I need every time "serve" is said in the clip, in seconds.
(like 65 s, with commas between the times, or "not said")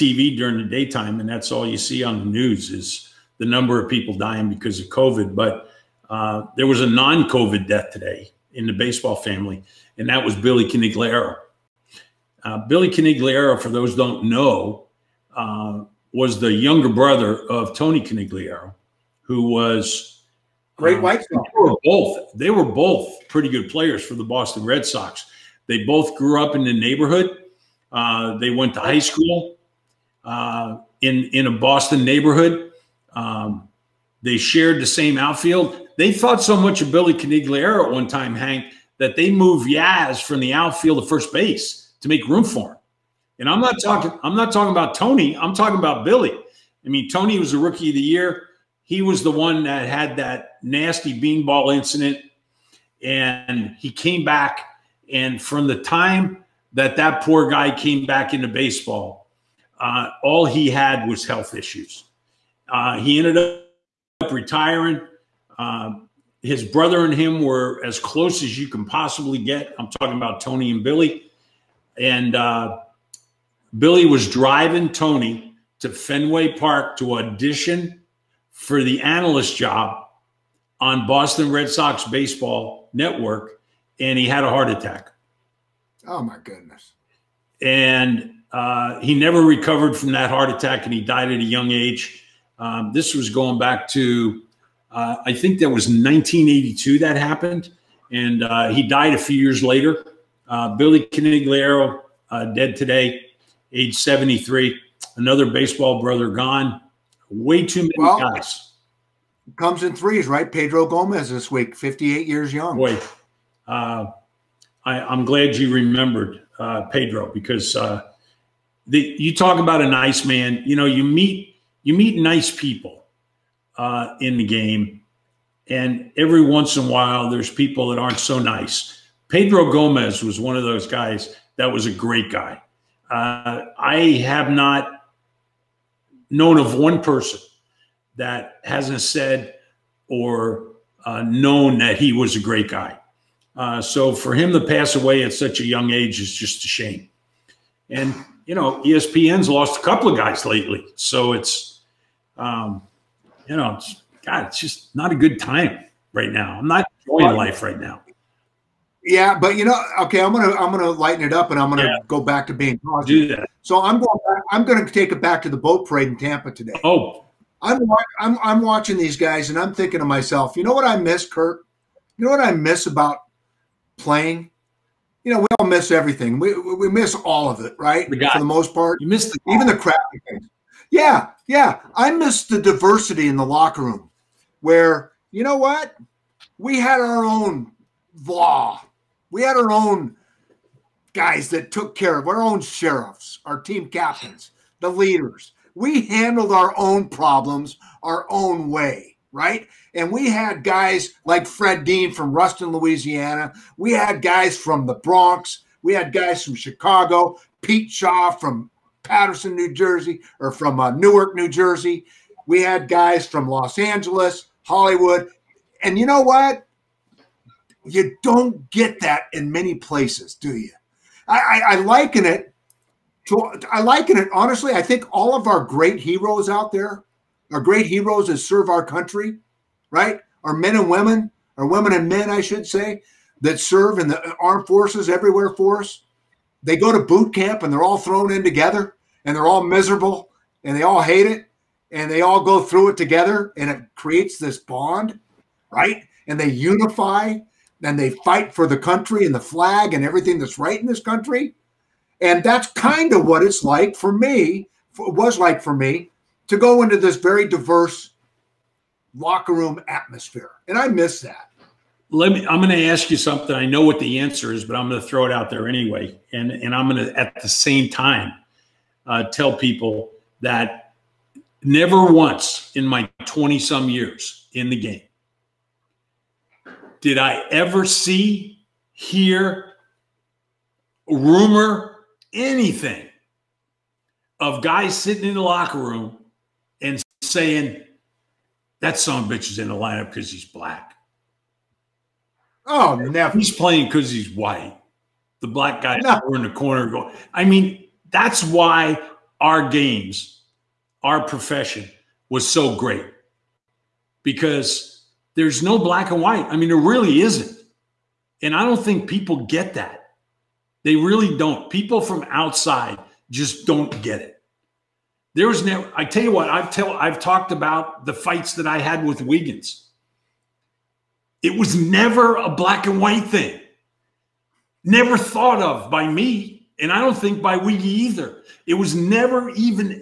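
228 s, 233 s.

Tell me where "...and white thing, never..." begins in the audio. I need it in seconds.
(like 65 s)
322 s.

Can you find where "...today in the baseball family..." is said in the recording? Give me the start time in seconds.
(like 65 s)
7 s.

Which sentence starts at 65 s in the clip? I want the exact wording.
Uh, his brother and him were as close as you can possibly get.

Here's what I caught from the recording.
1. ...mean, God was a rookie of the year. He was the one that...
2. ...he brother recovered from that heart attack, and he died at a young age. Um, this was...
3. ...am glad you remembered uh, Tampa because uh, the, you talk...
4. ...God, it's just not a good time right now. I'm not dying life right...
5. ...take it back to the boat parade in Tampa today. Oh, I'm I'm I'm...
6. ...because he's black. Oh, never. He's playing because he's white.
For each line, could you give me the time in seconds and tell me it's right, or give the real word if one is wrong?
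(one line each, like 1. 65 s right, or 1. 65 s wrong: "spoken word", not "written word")
1. 46 s wrong: "Tony", not "God"
2. 88 s wrong: "never", not "brother"
3. 115 s wrong: "Pedro", not "Tampa"
4. 154 s wrong: "enjoying", not "dying"
5. 164 s right
6. 290 s right.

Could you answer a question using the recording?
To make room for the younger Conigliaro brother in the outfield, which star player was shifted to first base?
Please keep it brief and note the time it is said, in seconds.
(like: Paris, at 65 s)
Yaz, at 39 s.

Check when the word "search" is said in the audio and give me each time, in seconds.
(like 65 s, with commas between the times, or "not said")
not said.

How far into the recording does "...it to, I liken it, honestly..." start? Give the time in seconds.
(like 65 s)
222 s.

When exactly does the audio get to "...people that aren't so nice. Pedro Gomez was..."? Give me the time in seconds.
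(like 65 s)
127 s.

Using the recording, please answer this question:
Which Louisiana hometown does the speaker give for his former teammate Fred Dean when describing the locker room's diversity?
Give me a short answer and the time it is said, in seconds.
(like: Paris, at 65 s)
Ruston, Louisiana, at 202 s.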